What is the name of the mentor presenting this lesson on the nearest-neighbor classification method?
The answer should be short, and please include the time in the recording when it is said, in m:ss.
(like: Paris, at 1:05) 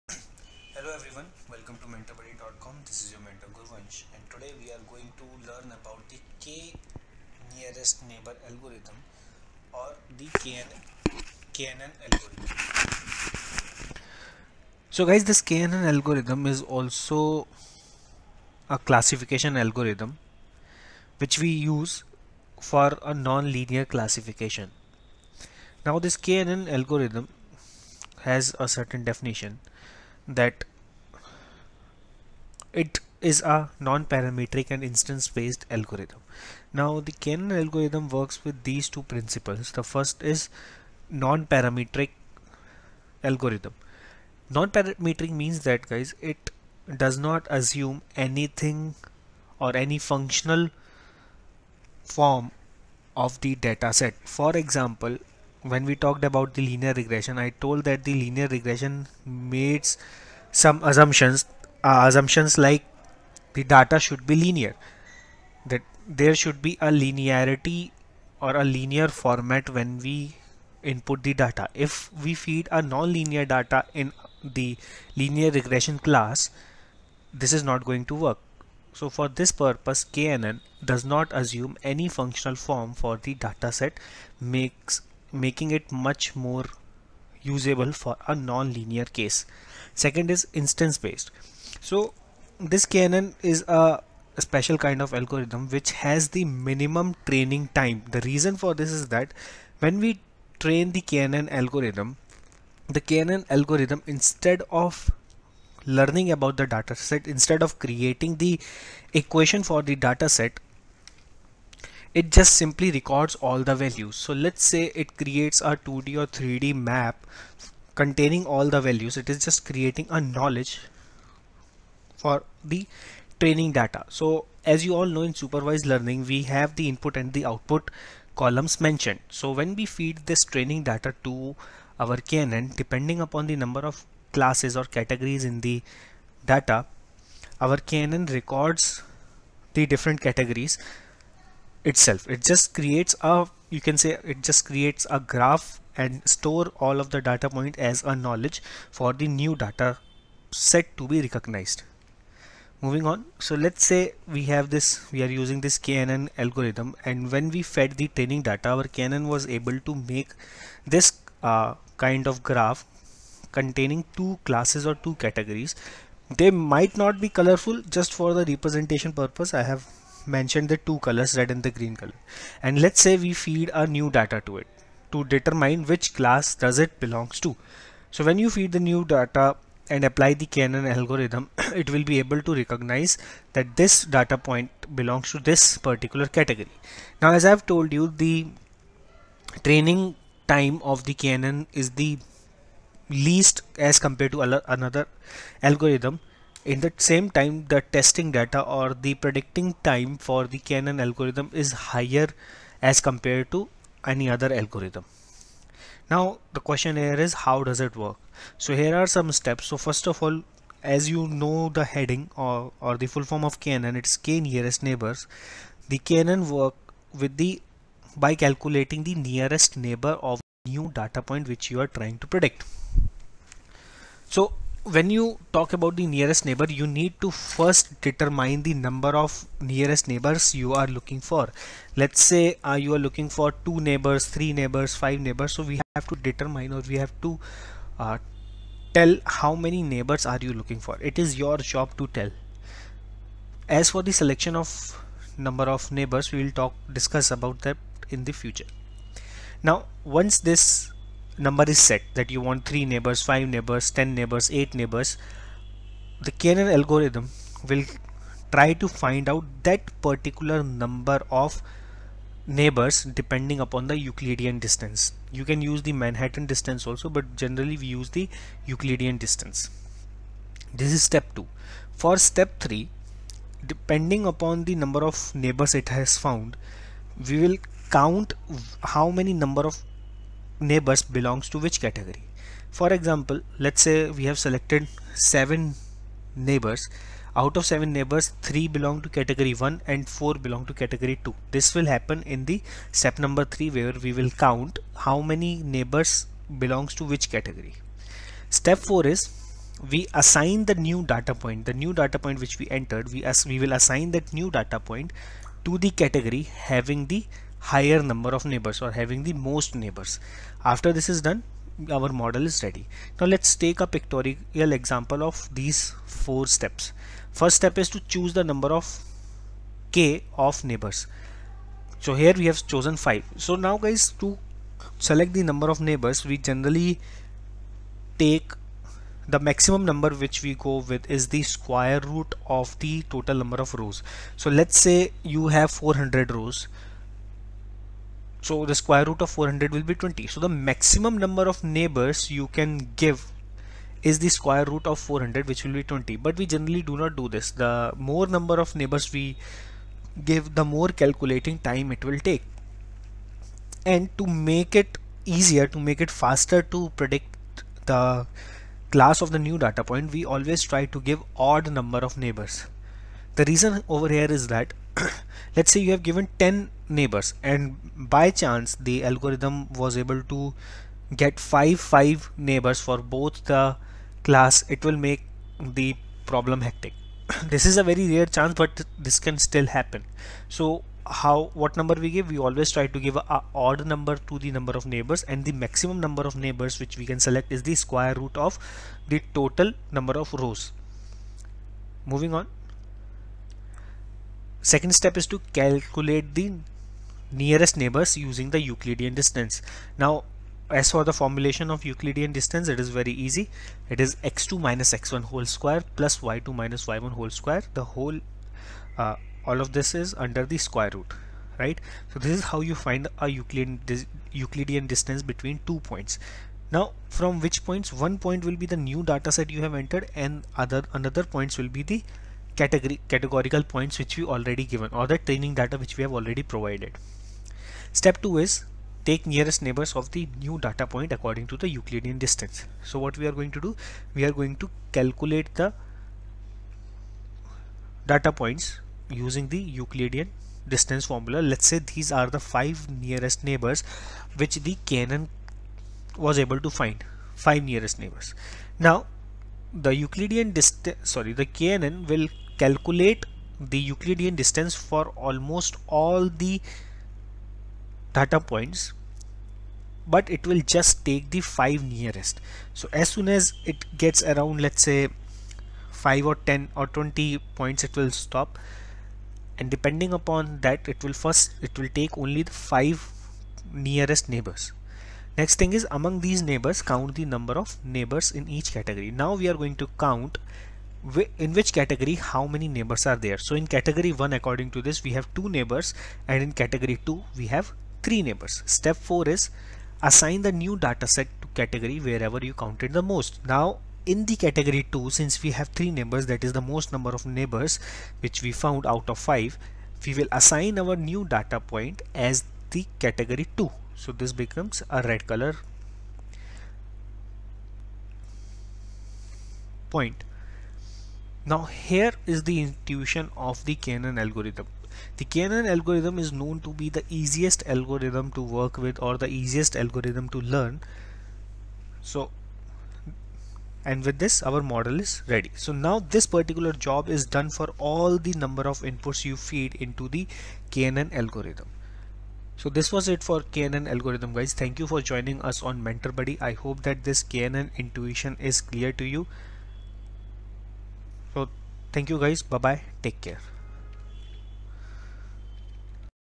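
Gurvansh, at 0:03.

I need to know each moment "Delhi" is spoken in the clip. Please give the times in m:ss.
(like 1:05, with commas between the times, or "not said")
not said.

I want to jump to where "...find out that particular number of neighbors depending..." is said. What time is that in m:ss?
4:18.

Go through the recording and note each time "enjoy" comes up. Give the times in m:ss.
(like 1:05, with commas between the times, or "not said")
not said.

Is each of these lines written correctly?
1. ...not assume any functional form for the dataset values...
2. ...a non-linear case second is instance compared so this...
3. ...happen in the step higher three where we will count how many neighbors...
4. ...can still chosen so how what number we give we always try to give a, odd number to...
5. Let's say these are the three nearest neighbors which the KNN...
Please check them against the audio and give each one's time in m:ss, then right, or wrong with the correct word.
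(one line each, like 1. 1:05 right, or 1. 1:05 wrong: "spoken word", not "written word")
1. 1:21 wrong: "makes", not "values"
2. 1:28 wrong: "based", not "compared"
3. 4:51 wrong: "number", not "higher"
4. 6:19 wrong: "happen", not "chosen"
5. 7:21 wrong: "five", not "three".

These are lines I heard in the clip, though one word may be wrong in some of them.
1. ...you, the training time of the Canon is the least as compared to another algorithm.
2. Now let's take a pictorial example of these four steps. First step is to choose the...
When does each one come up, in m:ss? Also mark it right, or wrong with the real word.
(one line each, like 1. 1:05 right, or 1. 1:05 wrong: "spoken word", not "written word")
1. 3:07 right
2. 5:13 right.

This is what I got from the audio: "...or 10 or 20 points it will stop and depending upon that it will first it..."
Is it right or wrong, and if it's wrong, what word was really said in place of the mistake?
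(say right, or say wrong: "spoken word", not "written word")
right.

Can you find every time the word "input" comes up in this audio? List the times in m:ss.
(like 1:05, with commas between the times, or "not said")
1:10, 2:06, 8:48.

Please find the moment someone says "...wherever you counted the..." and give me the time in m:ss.
8:11.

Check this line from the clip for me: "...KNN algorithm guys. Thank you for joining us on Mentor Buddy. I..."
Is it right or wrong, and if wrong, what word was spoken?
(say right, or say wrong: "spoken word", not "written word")
right.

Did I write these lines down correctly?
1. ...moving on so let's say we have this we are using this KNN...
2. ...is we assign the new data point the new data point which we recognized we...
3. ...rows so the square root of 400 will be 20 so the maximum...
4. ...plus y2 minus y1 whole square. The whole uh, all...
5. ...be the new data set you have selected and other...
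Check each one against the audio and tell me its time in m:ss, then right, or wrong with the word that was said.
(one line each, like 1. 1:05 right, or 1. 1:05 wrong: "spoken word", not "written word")
1. 2:32 right
2. 4:59 wrong: "entered", not "recognized"
3. 5:36 right
4. 6:45 right
5. 6:58 wrong: "entered", not "selected".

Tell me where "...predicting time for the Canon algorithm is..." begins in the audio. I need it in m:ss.
3:19.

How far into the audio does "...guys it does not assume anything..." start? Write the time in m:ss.
0:45.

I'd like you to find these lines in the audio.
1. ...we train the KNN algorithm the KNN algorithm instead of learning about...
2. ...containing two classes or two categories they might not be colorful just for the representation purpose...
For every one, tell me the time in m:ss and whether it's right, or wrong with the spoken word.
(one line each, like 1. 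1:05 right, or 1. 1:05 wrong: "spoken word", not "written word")
1. 1:39 right
2. 2:43 right.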